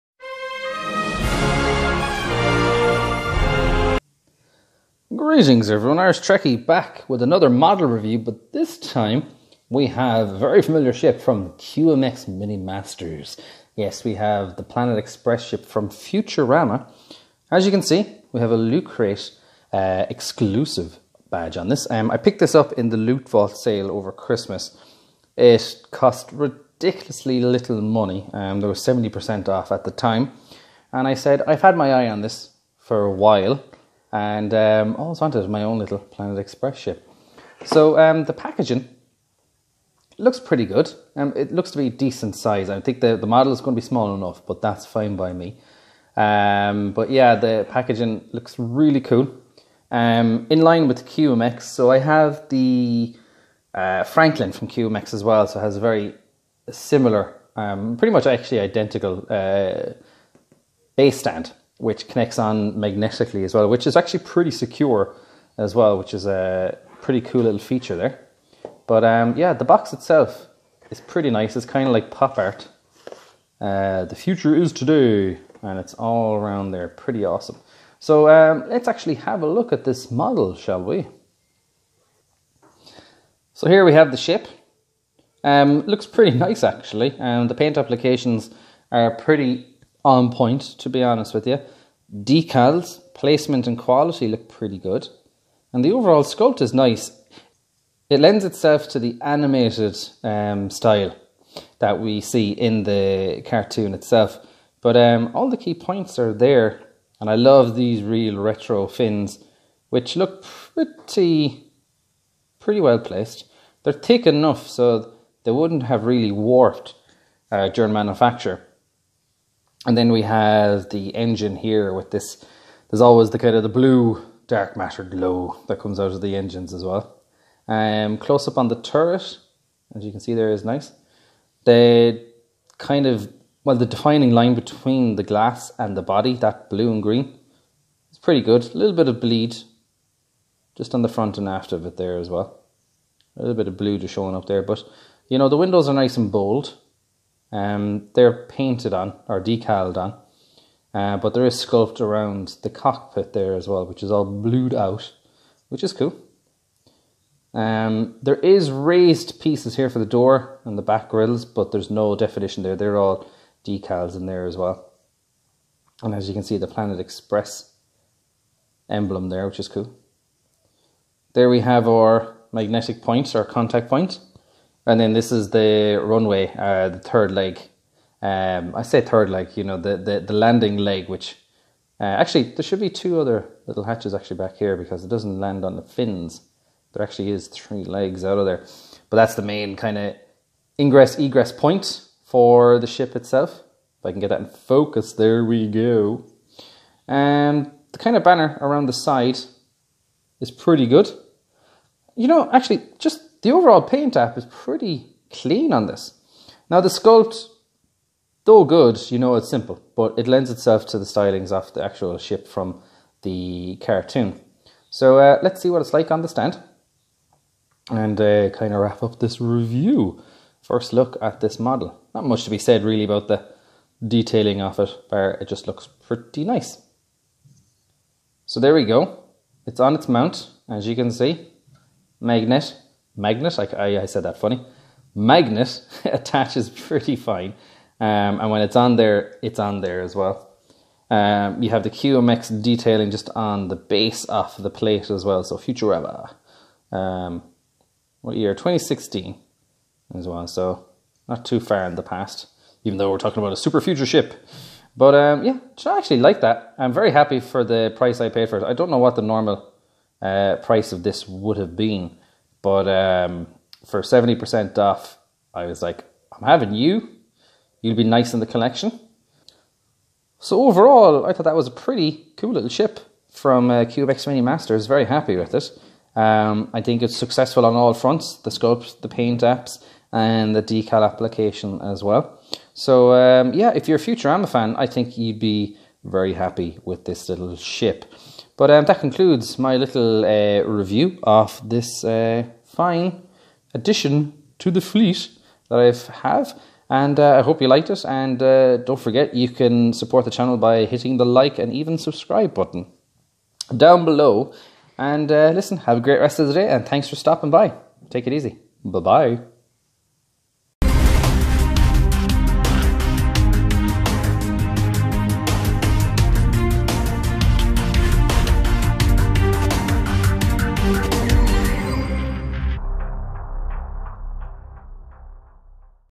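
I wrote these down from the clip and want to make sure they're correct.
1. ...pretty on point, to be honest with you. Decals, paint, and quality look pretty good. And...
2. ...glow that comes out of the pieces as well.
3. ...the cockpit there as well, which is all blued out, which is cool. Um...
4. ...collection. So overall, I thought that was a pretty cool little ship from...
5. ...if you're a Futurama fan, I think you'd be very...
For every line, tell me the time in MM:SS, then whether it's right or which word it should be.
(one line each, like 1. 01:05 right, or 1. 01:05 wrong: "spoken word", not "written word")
1. 01:29 wrong: "placement", not "paint"
2. 02:05 wrong: "engines", not "pieces"
3. 02:32 right
4. 04:28 right
5. 04:43 right.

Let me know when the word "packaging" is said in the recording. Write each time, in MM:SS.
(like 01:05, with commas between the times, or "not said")
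00:38, 00:47.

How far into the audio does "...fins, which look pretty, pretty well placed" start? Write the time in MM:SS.
01:48.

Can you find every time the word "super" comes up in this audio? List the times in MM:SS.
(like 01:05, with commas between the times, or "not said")
04:13.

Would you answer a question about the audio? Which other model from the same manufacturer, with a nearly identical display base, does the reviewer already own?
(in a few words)
Franklin.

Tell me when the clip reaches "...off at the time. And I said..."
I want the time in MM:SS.
00:29.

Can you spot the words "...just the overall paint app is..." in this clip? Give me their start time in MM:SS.
03:22.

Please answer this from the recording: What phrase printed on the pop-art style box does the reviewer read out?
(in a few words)
The future is today.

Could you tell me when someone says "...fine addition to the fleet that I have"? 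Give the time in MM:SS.
04:52.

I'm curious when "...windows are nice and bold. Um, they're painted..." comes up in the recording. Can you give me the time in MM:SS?
02:25.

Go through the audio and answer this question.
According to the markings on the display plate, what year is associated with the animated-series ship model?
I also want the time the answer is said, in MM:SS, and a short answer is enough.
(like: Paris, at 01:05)
2016, at 04:08.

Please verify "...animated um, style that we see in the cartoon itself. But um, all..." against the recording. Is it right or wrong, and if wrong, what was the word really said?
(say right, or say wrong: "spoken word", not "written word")
right.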